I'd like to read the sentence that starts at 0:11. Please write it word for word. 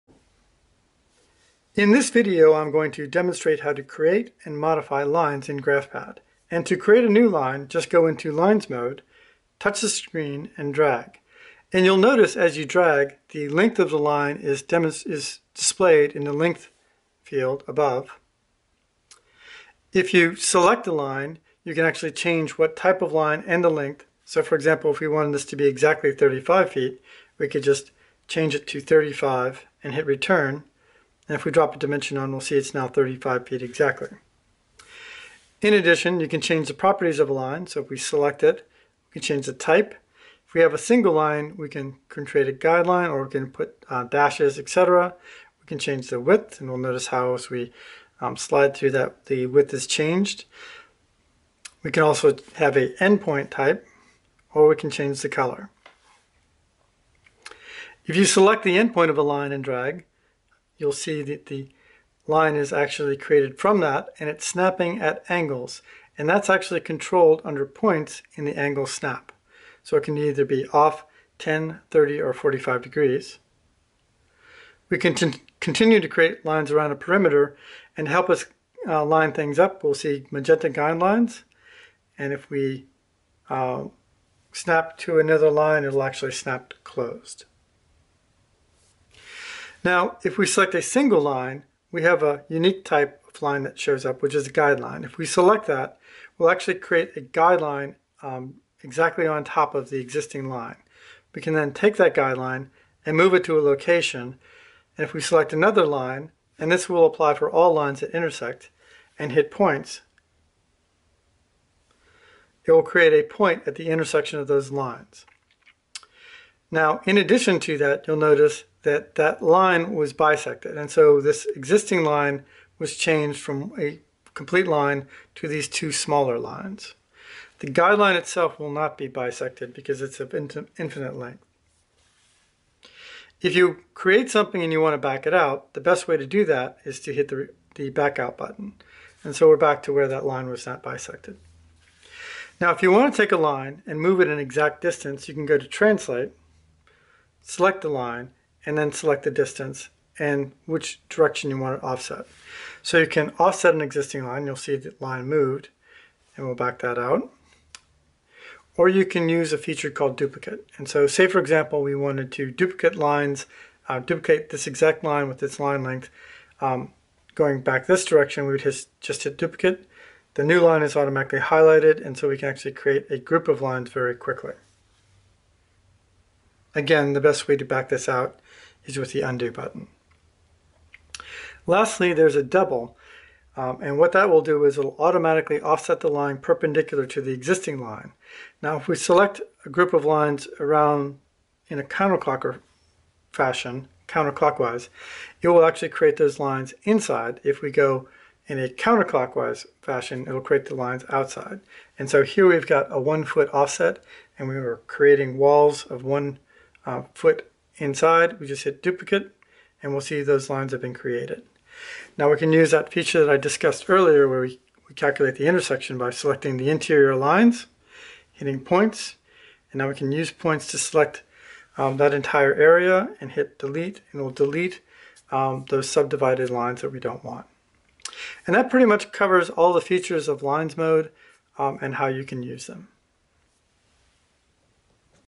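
And you'll notice as you drag, the length of the line is, is displayed in the length field above.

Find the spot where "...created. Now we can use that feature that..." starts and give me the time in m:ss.
3:30.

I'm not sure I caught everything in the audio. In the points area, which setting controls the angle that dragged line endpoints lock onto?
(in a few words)
angle snap.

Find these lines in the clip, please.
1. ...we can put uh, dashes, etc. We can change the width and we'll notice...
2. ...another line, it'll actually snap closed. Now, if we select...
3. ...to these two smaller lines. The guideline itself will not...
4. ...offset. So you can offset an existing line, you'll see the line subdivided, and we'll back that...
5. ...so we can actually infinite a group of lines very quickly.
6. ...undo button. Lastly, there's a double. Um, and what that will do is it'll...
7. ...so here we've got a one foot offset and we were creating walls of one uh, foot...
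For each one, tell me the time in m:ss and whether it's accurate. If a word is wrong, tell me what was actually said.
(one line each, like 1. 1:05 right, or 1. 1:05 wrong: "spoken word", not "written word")
1. 0:43 right
2. 1:25 right
3. 2:05 right
4. 2:31 wrong: "moved", not "subdivided"
5. 2:52 wrong: "create", not "infinite"
6. 2:59 right
7. 3:22 right.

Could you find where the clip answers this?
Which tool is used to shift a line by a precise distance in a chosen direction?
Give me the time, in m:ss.
2:25.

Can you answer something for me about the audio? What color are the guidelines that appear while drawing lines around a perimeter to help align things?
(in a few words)
magenta.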